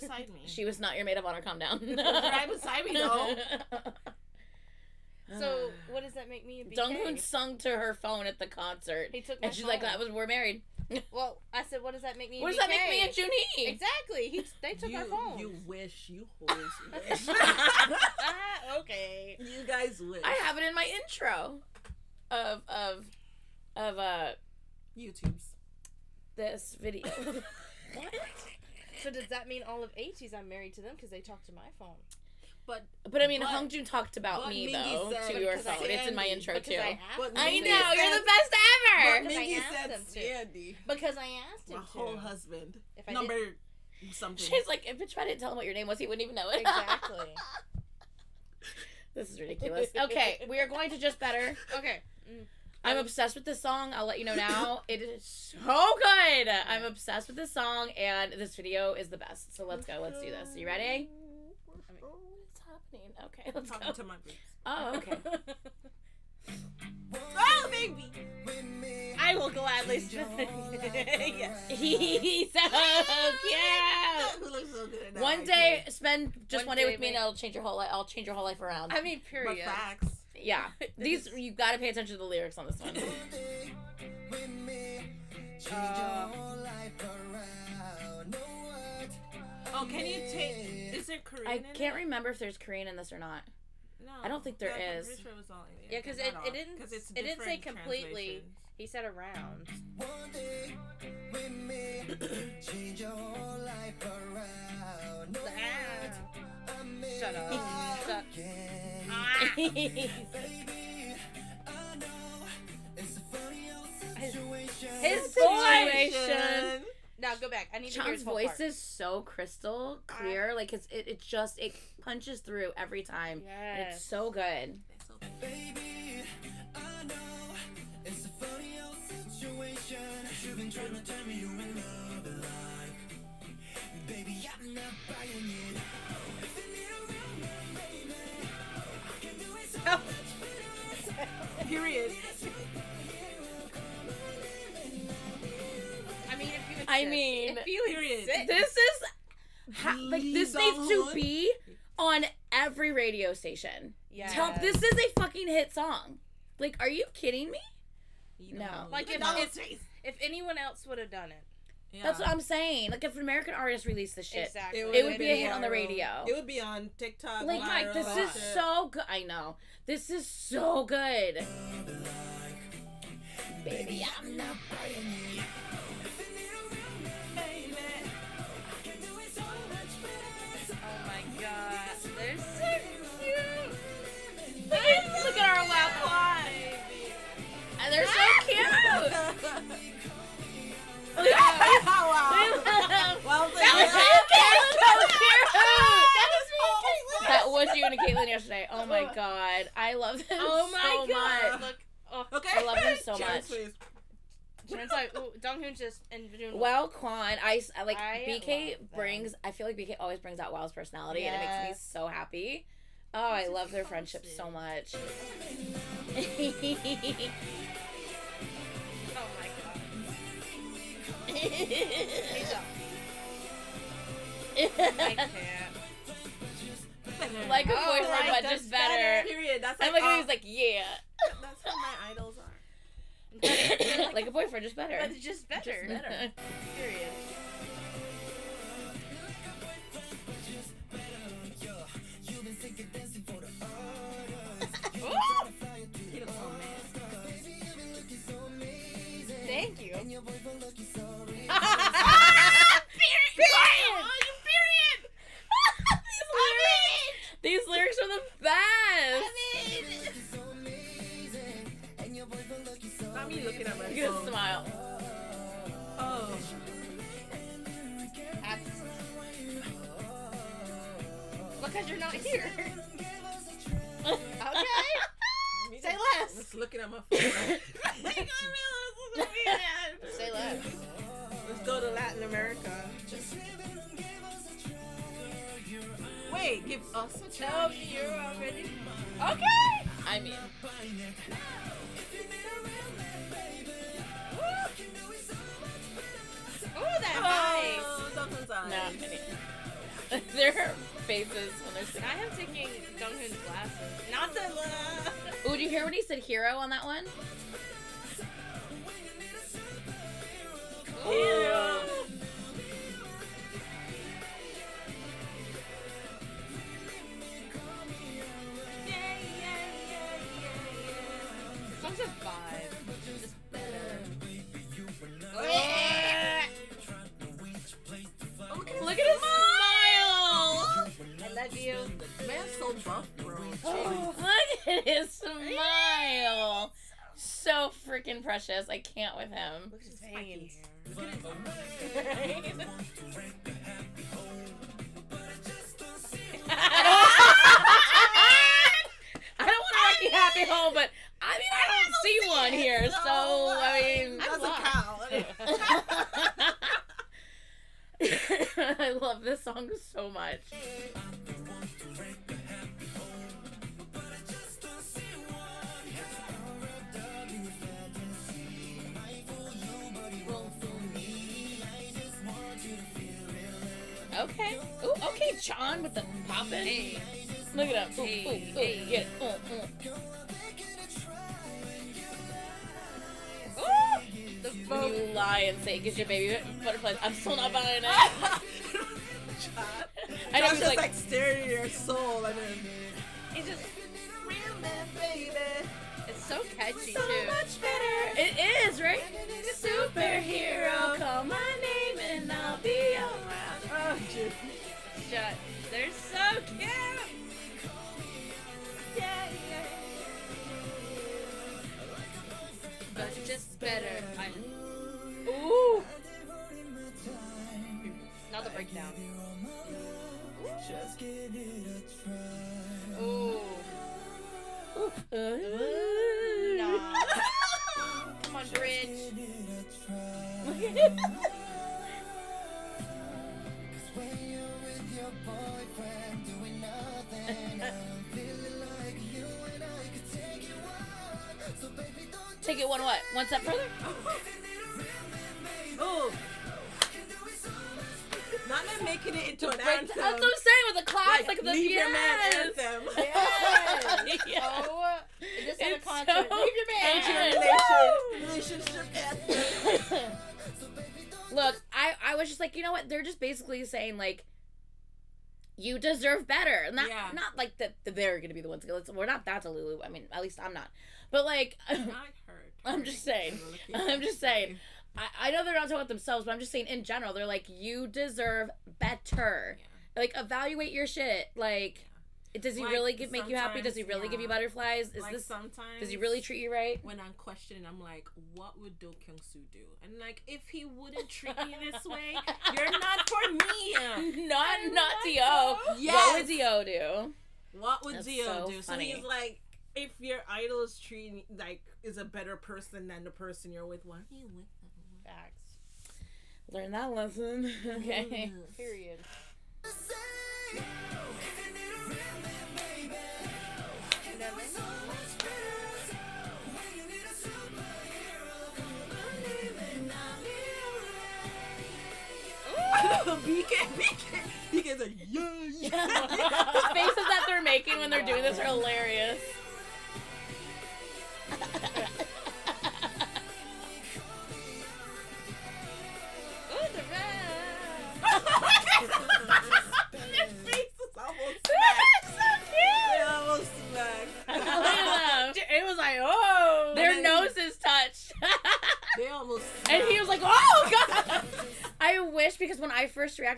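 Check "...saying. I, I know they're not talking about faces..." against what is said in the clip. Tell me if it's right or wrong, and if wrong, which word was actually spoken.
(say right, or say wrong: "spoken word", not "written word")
wrong: "themselves", not "faces".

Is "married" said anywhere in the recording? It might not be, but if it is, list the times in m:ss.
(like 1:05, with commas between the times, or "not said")
0:10, 0:30.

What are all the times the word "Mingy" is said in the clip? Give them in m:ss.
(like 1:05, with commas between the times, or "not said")
0:34, 0:39.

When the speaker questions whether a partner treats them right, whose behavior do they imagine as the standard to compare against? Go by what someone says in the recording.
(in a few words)
Do Kyung Soo.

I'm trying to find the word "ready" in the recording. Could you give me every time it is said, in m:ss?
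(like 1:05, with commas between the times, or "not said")
1:00.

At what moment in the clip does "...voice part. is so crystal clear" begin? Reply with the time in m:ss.
1:58.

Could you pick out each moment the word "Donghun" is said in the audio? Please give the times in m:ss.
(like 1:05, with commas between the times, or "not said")
0:06, 3:25.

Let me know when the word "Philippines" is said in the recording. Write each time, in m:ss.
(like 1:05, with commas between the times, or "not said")
not said.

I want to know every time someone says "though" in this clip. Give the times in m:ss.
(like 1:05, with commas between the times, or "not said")
0:02, 0:34.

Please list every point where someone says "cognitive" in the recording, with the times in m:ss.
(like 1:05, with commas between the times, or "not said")
not said.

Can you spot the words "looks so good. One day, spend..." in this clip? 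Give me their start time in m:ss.
1:14.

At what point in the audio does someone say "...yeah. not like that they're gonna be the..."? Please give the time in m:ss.
7:46.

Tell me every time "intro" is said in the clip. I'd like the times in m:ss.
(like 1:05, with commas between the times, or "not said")
0:21, 0:36.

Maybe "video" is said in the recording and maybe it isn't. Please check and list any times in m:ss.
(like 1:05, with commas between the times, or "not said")
0:26, 0:58.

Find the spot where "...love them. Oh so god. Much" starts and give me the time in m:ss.
3:19.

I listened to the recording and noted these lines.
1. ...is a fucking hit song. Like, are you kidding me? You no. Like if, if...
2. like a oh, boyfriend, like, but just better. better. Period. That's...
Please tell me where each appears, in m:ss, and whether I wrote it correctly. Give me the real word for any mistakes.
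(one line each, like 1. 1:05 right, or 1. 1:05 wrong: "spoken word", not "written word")
1. 2:34 right
2. 3:47 right.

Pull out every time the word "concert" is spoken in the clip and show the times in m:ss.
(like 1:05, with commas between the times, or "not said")
0:08, 7:35.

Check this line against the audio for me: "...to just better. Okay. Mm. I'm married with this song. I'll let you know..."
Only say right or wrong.
wrong.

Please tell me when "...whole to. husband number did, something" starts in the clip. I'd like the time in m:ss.
0:41.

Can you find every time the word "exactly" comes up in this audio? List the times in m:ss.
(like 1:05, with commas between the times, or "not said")
0:13, 0:46, 2:44.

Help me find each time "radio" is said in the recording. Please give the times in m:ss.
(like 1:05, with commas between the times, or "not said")
2:32, 2:45.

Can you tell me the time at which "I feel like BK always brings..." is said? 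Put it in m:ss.
3:29.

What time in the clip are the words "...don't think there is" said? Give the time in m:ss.
1:34.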